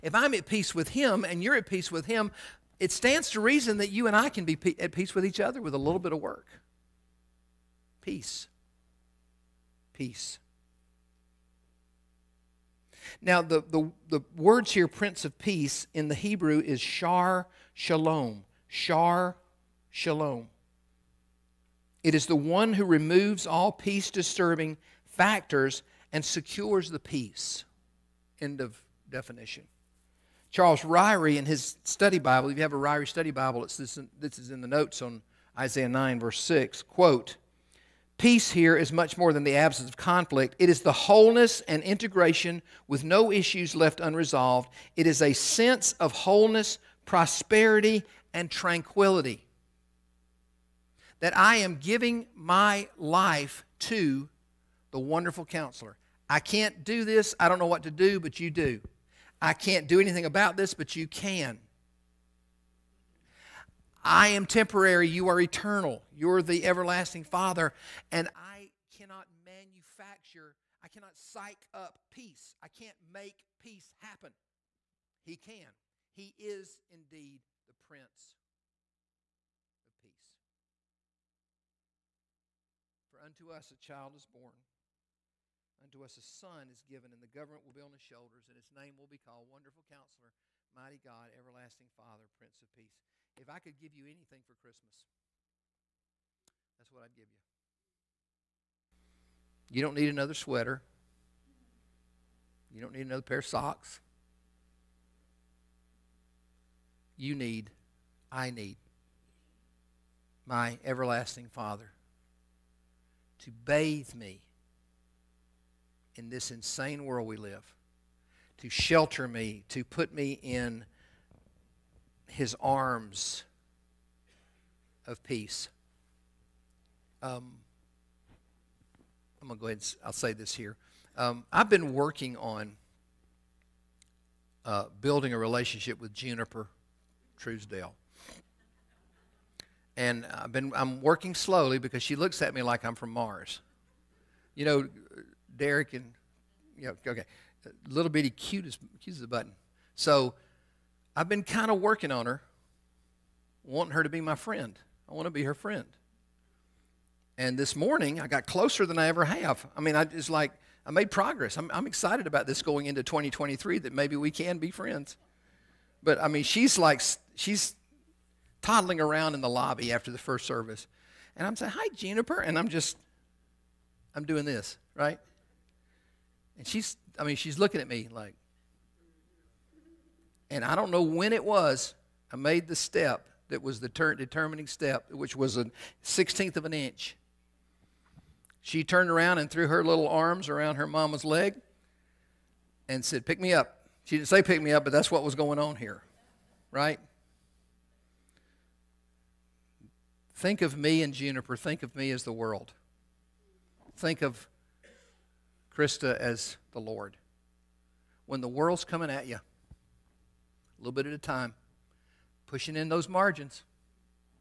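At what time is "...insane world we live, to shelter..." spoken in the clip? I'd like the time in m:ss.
1:56.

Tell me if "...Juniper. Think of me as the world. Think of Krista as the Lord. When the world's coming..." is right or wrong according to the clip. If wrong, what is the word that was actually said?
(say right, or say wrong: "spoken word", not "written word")
right.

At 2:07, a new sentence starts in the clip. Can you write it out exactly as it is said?
Um, I'm going to go ahead and I'll say this here.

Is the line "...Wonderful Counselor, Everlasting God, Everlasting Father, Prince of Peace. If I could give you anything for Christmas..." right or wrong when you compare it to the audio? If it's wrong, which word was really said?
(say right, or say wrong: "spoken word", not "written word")
wrong: "Mighty", not "Everlasting".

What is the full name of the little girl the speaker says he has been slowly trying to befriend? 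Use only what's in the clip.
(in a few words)
Juniper Truesdale.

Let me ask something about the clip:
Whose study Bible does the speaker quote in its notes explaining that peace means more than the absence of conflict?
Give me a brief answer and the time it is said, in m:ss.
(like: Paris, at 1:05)
Charles Ryrie, at 0:30.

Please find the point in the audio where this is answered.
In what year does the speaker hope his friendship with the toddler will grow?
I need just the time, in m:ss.
2:43.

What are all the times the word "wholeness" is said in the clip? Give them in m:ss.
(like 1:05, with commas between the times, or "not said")
0:40, 0:46.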